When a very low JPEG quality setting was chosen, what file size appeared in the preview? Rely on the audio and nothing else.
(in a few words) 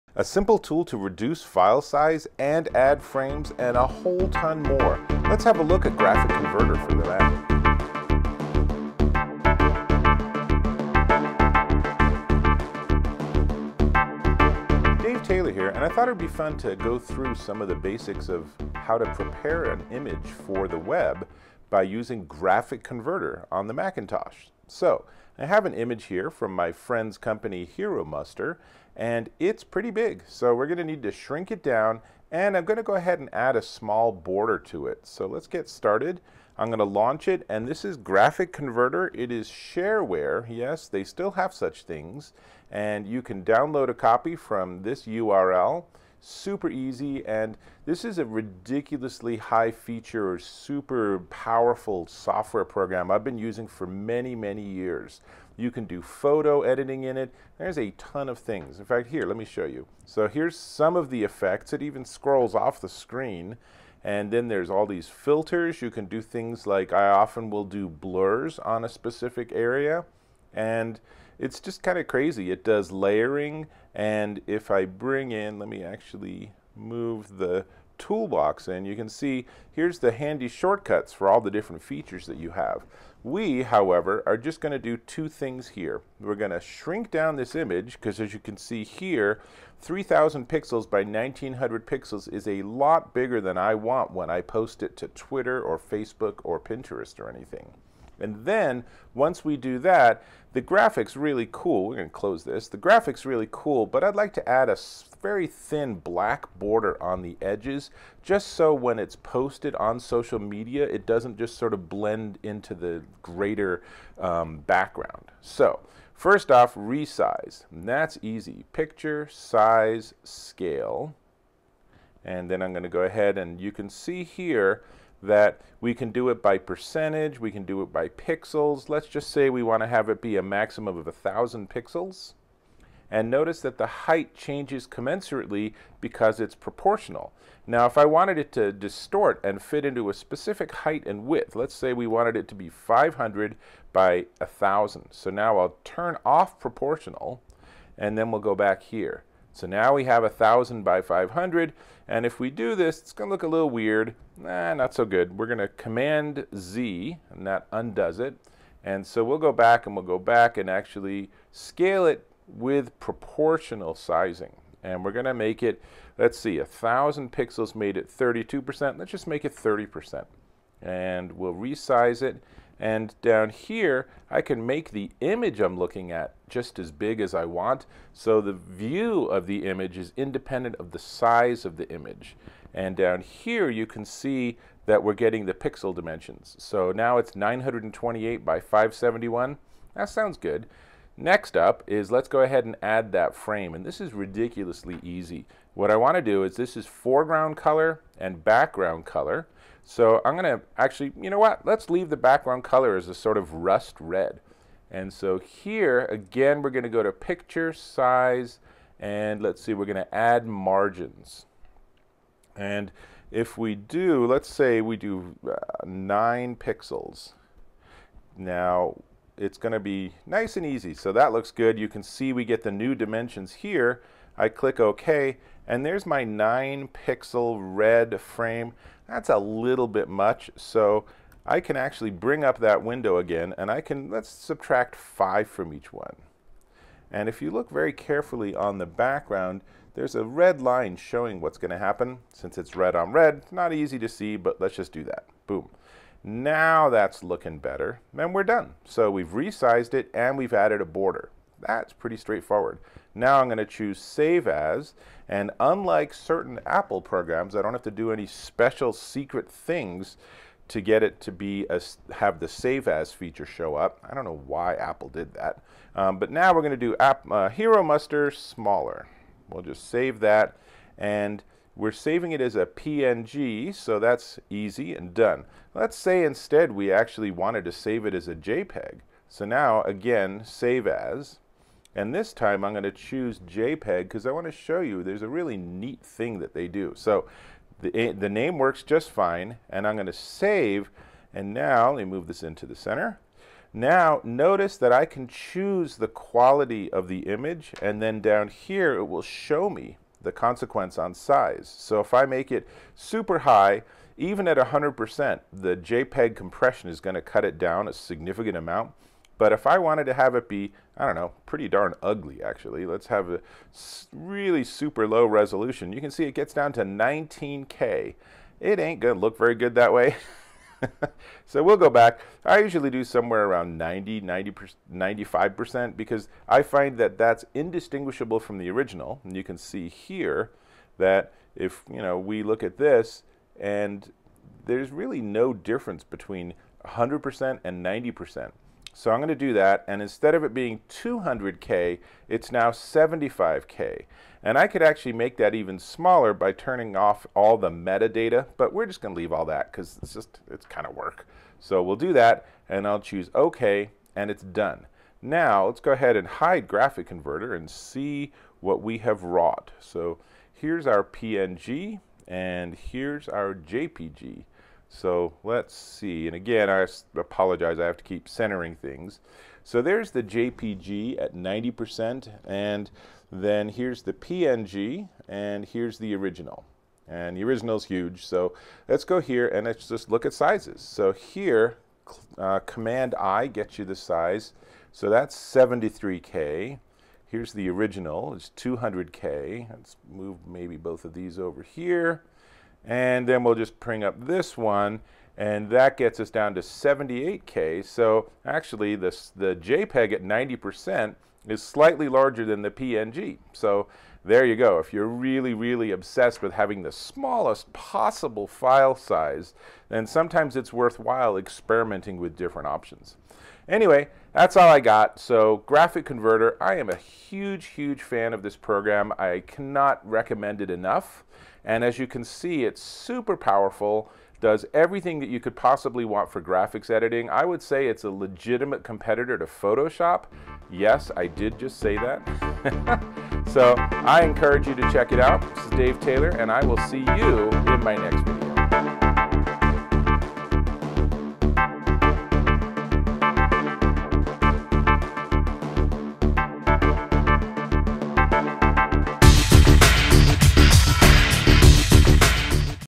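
19K.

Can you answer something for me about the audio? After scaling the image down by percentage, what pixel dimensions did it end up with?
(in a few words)
928 by 571.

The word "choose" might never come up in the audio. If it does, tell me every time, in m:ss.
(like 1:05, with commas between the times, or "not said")
4:13, 4:42, 4:55, 5:52.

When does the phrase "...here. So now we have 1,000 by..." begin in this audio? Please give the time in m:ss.
2:28.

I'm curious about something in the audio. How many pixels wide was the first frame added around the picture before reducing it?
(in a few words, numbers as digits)
9.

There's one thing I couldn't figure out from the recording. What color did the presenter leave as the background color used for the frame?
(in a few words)
rust red.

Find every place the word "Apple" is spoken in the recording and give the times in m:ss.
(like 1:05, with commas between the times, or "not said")
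4:16, 4:24.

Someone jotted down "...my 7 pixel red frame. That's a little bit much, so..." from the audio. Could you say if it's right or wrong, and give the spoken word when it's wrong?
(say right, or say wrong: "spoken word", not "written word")
wrong: "9", not "7".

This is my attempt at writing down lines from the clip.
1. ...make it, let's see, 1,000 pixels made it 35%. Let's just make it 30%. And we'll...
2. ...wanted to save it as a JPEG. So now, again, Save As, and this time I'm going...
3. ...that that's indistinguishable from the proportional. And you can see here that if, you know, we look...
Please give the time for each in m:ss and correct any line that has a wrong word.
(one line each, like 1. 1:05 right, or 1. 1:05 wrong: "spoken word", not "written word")
1. 2:45 wrong: "32", not "35"
2. 4:37 right
3. 5:26 wrong: "original", not "proportional".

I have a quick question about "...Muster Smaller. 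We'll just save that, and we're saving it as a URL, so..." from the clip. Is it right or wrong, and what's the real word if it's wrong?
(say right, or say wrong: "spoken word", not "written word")
wrong: "PNG", not "URL".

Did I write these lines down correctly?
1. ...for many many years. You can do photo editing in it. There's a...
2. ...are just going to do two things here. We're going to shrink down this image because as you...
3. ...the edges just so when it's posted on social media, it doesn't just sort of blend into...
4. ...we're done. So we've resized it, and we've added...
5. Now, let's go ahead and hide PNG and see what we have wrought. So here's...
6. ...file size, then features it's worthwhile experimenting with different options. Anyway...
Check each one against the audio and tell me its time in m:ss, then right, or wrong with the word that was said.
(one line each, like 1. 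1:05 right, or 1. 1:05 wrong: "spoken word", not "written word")
1. 0:53 right
2. 1:24 right
3. 1:47 right
4. 4:08 right
5. 5:55 wrong: "GraphicConverter", not "PNG"
6. 6:48 wrong: "sometimes", not "features".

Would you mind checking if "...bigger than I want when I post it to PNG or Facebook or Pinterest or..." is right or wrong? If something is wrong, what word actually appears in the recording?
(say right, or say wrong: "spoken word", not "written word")
wrong: "Twitter", not "PNG".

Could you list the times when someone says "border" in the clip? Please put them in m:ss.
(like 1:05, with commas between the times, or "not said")
0:34, 1:46, 4:10.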